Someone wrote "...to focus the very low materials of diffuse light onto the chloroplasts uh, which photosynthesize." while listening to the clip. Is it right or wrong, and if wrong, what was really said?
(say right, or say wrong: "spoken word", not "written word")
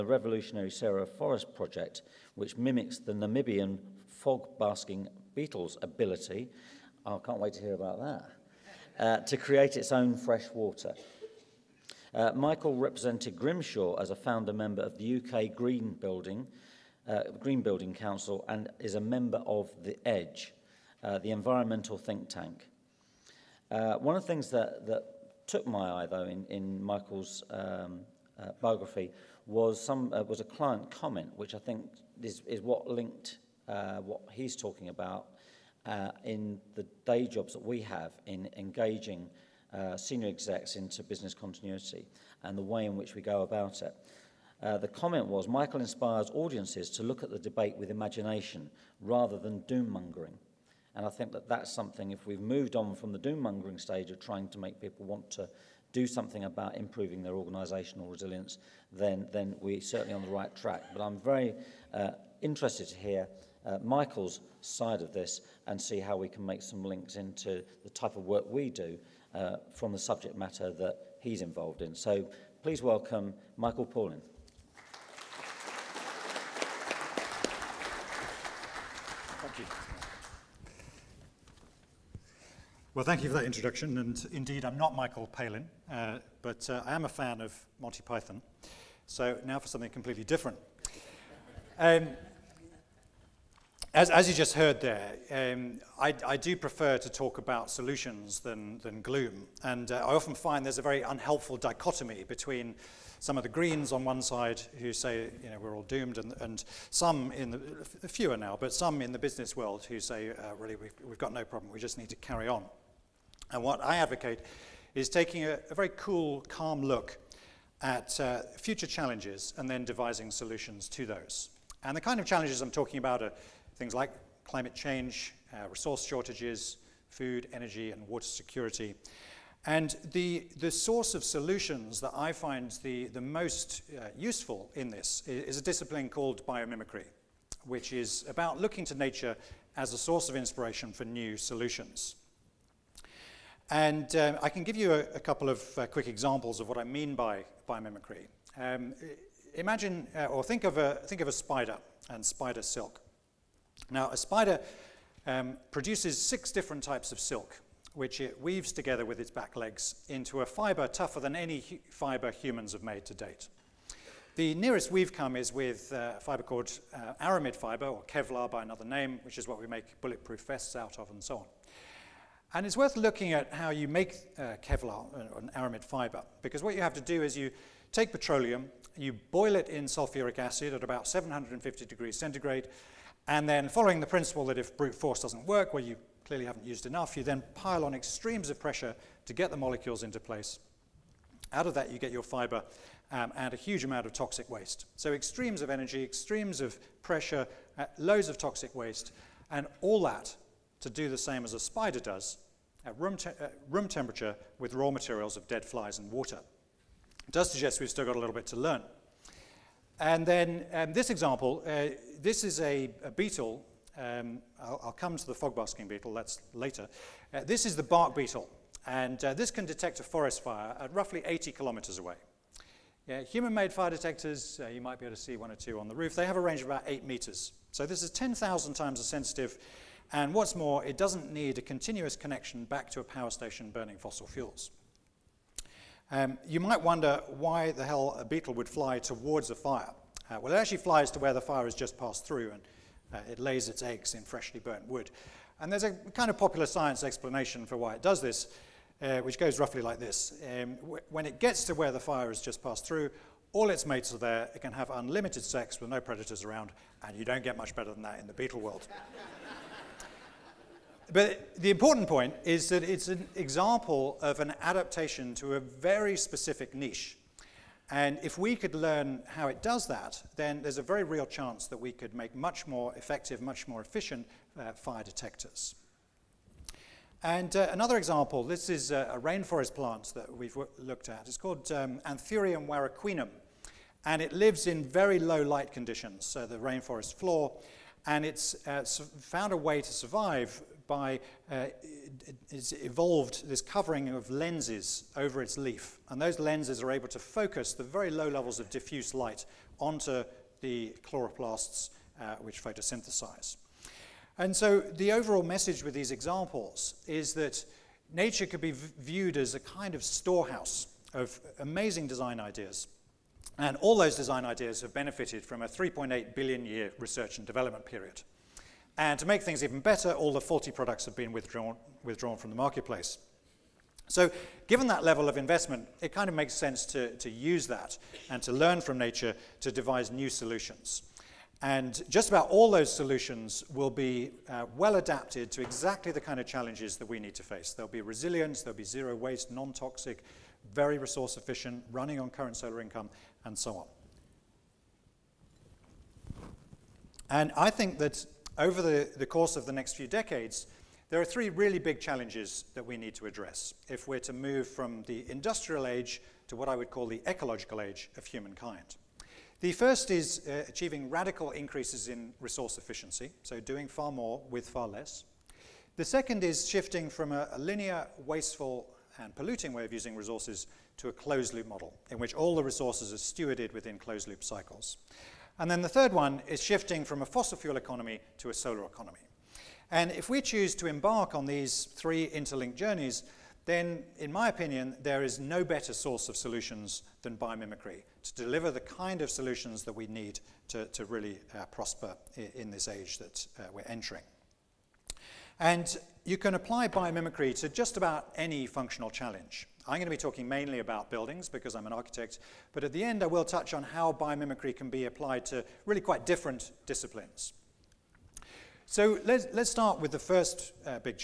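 wrong: "levels", not "materials".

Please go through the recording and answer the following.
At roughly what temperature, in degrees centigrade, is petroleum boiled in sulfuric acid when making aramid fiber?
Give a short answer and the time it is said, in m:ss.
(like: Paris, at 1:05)
750, at 3:01.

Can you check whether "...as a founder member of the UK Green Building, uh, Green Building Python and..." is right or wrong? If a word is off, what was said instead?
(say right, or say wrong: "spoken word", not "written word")
wrong: "Council", not "Python".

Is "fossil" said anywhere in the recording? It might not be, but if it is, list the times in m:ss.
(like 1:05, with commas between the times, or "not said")
3:53, 6:17.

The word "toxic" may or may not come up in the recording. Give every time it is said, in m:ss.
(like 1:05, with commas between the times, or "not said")
3:14, 3:18, 5:39.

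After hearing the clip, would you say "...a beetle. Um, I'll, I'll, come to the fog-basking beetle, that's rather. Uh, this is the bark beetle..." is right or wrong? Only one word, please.
wrong.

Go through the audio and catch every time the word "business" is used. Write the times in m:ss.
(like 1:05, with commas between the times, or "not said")
0:41, 1:49.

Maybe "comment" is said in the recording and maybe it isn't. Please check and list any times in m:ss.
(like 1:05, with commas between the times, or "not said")
0:30, 0:44.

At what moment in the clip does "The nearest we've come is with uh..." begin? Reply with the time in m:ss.
2:44.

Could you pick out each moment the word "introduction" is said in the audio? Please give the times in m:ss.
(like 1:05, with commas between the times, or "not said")
1:23.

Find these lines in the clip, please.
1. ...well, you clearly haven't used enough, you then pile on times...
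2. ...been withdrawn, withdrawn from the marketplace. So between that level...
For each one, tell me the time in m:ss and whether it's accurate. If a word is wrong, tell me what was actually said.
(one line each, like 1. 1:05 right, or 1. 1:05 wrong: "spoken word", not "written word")
1. 3:05 wrong: "extremes", not "times"
2. 5:21 wrong: "given", not "between".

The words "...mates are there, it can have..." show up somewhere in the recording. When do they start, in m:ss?
4:13.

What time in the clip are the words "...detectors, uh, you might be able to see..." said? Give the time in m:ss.
3:43.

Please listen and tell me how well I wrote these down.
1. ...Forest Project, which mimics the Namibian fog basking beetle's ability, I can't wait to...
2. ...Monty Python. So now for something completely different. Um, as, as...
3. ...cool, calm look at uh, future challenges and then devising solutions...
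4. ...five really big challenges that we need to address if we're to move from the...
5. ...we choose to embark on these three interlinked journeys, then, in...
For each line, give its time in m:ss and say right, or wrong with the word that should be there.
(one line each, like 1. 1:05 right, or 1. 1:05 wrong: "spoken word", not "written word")
1. 0:01 right
2. 1:27 right
3. 1:55 right
4. 5:51 wrong: "three", not "five"
5. 6:20 right.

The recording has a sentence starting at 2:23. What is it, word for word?
And um, I can give you a, a couple of uh, quick examples of what I mean by biomimicry.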